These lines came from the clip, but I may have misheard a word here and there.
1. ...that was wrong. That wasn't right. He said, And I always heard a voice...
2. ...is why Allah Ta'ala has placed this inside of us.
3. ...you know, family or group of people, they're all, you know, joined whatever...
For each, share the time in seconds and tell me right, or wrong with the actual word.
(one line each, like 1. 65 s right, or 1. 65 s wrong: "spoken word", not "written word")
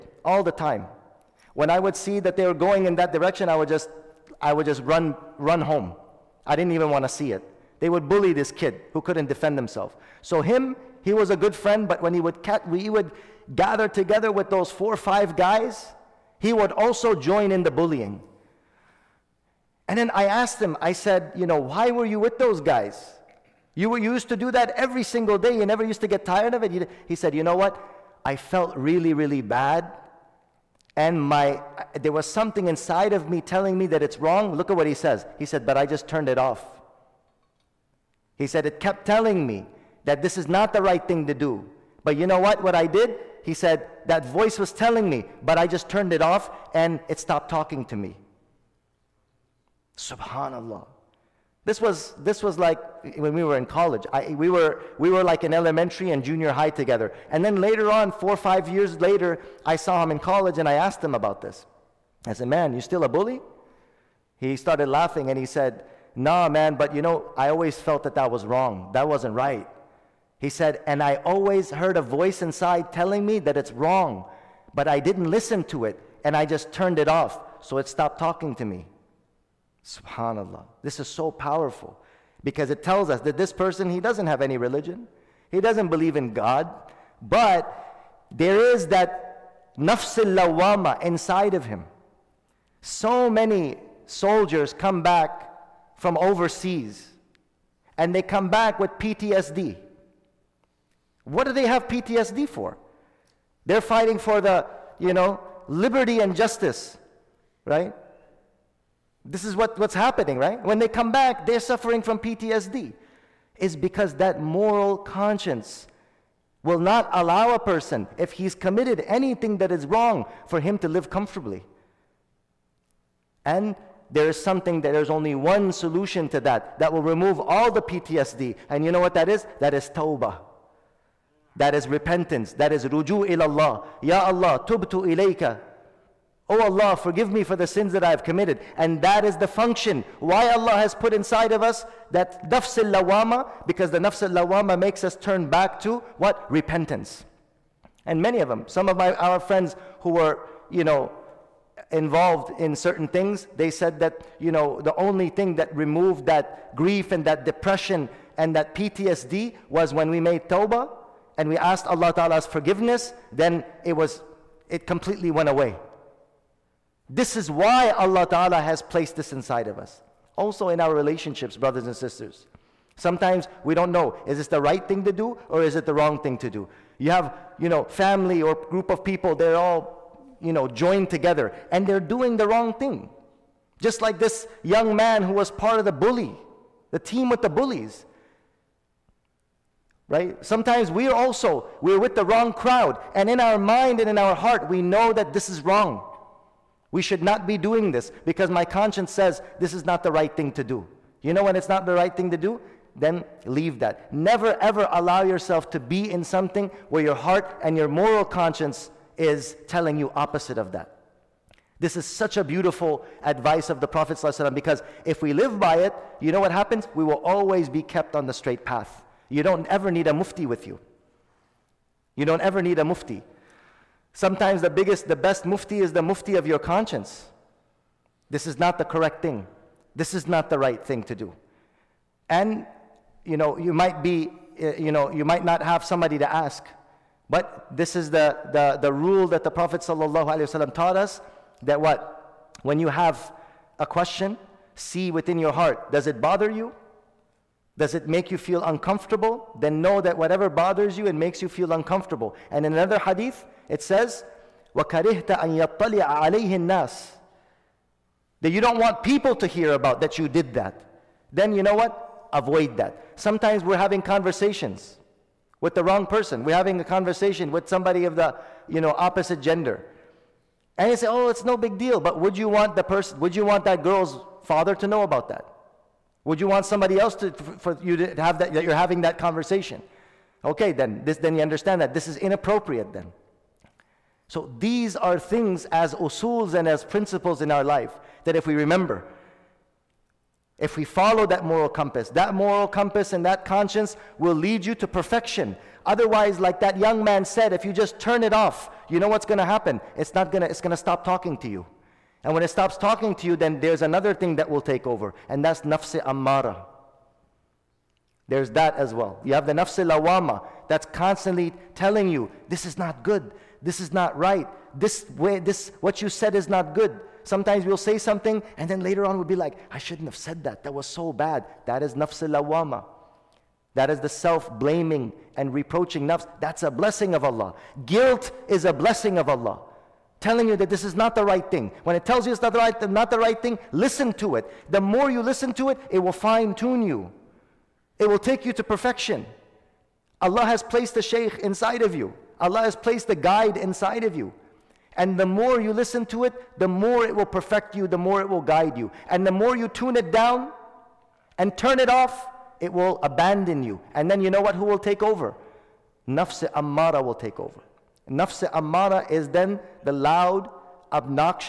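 1. 68 s right
2. 167 s right
3. 177 s wrong: "together", not "whatever".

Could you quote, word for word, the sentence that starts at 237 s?
But this is the, the, the rule that the Prophet ﷺ taught us that what?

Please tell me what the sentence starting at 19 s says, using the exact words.
And then I asked him, I said, you know, why were you with those guys?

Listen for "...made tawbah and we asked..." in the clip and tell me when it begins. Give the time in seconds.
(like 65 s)
160 s.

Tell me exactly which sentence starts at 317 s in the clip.
Sometimes we'll say something, and then later on we'll be like, I shouldn't have said that.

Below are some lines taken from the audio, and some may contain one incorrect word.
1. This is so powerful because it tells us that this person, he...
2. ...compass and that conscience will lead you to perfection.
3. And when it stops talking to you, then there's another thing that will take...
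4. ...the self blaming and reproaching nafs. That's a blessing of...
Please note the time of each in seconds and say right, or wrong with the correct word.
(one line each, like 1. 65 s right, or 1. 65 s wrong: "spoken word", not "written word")
1. 80 s right
2. 292 s right
3. 302 s right
4. 323 s right.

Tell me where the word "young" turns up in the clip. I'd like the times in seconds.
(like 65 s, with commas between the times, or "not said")
184 s, 296 s.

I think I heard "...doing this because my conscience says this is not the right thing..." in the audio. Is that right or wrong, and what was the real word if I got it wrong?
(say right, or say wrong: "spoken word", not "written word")
right.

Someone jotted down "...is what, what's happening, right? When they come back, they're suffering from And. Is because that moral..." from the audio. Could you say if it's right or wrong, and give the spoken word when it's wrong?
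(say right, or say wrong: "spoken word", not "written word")
wrong: "PTSD", not "And".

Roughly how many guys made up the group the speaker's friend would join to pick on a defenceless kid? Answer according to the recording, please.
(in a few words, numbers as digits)
4 or 5.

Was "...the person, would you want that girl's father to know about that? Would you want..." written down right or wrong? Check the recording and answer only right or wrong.
right.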